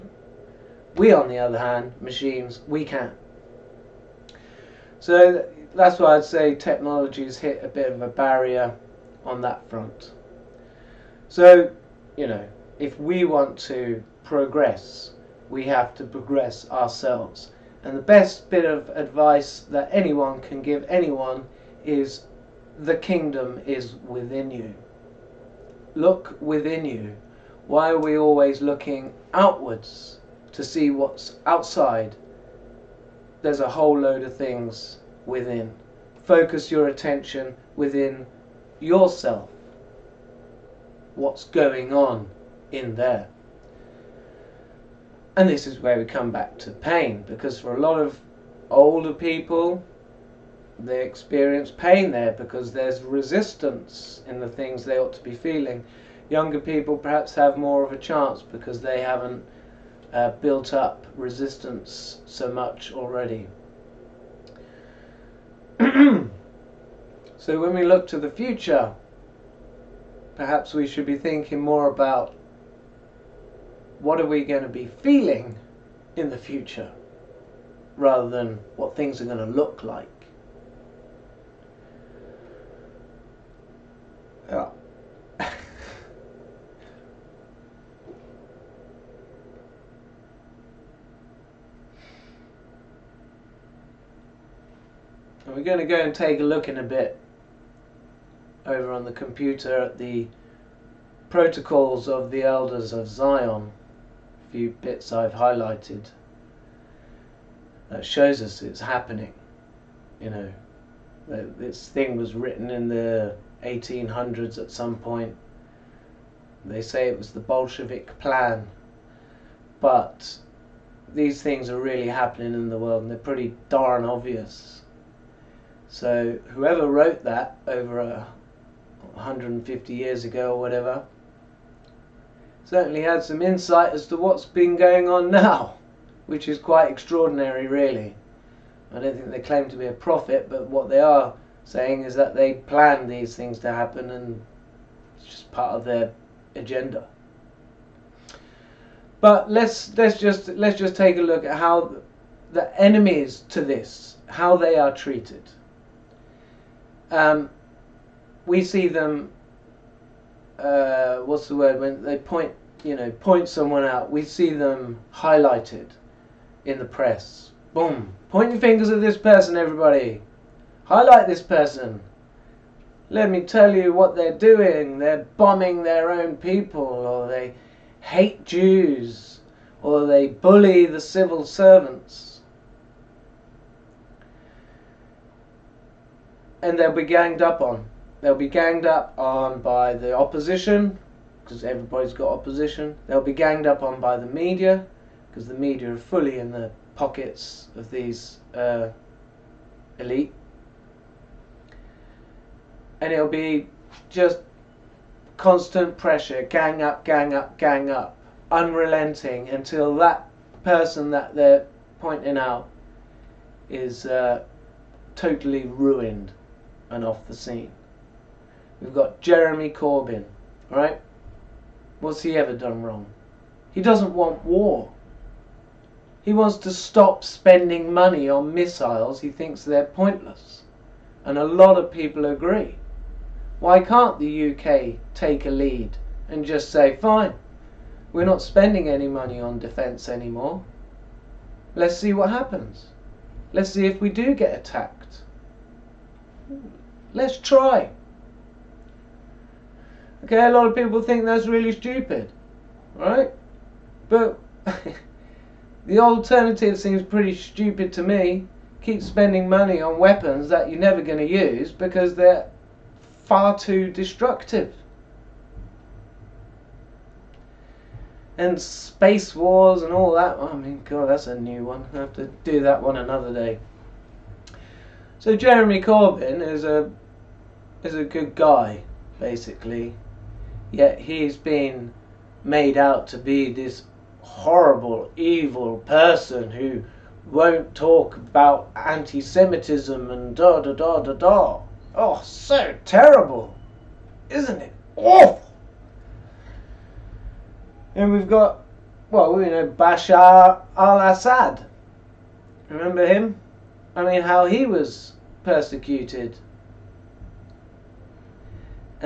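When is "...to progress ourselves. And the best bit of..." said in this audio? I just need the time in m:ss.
0:15.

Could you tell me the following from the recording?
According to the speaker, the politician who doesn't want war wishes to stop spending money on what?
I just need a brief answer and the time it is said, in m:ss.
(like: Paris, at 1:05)
Missiles, at 3:48.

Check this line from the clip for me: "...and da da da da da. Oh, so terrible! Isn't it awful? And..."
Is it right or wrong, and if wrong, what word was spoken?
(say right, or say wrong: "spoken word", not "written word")
right.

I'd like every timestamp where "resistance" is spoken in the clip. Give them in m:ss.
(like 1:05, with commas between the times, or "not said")
0:53, 1:01.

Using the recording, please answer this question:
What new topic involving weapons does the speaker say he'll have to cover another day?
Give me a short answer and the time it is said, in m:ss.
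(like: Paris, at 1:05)
Space wars, at 4:28.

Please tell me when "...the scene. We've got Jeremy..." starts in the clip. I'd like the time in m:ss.
3:37.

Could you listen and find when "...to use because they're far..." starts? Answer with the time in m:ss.
4:21.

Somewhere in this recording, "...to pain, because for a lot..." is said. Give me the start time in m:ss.
0:46.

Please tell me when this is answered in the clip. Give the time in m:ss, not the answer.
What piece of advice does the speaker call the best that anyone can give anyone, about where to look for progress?
0:22.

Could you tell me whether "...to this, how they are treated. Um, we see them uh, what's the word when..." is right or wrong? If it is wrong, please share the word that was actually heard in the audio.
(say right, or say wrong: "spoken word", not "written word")
right.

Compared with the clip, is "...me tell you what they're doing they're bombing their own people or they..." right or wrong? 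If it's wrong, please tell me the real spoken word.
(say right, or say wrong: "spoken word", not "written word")
right.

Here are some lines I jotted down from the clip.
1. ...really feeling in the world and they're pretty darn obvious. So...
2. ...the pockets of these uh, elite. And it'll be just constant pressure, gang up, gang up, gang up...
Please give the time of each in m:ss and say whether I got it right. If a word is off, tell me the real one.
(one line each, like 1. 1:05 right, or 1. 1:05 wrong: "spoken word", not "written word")
1. 2:01 wrong: "happening", not "feeling"
2. 3:16 right.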